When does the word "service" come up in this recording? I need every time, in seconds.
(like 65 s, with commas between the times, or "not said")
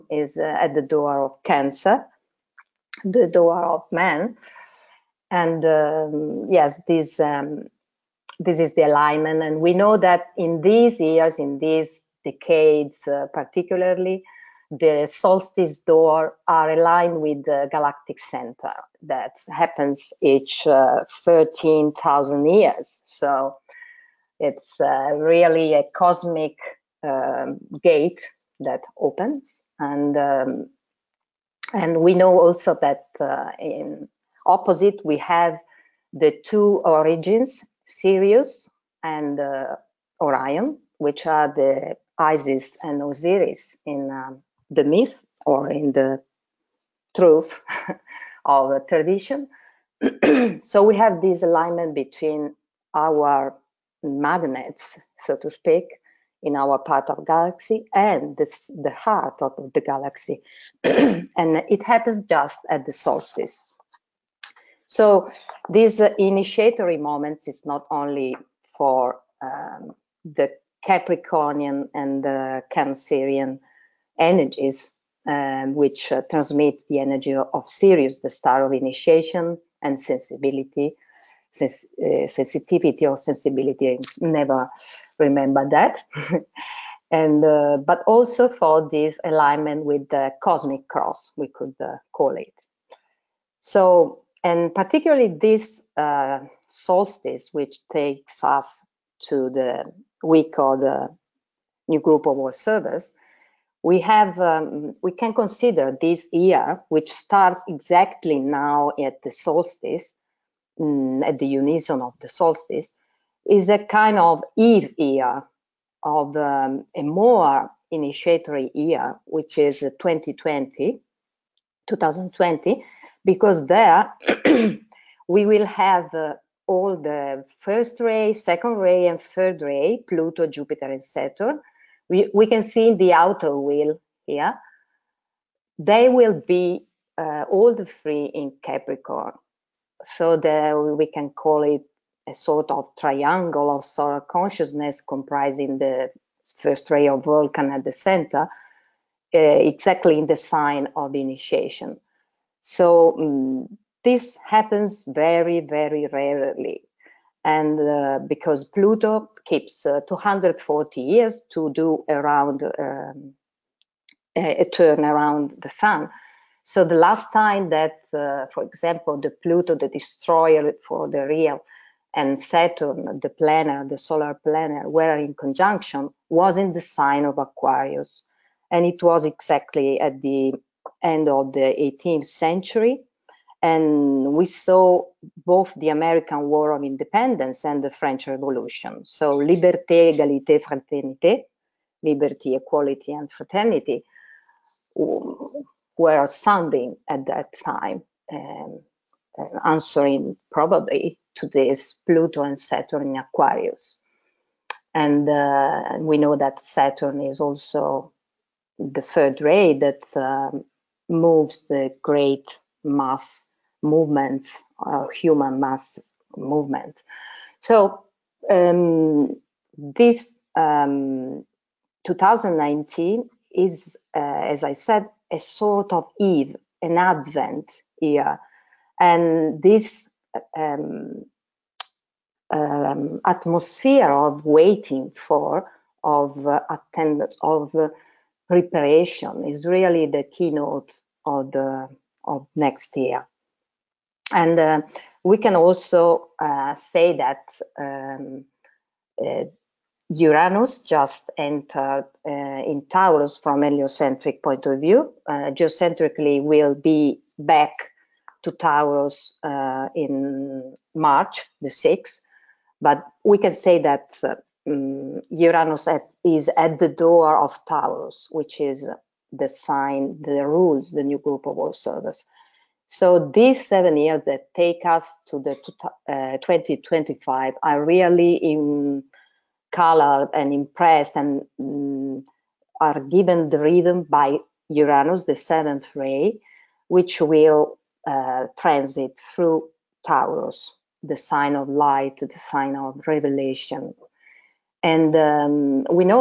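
102 s, 271 s.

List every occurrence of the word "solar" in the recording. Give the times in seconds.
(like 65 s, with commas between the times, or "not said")
143 s, 173 s.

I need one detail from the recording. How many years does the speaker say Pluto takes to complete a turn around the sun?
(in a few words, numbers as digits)
240.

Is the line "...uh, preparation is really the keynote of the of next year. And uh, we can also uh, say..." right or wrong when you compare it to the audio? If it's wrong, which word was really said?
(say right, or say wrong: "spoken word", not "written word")
right.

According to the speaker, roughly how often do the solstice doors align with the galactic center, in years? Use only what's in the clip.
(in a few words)
13,000.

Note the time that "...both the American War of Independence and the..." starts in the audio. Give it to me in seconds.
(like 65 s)
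185 s.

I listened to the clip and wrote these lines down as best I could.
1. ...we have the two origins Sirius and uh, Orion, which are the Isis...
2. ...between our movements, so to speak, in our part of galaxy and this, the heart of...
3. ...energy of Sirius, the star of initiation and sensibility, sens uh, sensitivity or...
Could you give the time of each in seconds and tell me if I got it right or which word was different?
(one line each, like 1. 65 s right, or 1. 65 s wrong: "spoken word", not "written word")
1. 35 s right
2. 51 s wrong: "magnets", not "movements"
3. 77 s right.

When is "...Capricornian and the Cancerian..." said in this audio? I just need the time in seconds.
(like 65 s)
70 s.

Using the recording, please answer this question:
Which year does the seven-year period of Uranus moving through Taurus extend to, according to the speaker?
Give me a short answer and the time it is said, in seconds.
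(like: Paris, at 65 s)
2025, at 276 s.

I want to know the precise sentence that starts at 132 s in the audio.
We, we can see in the outer wheel here.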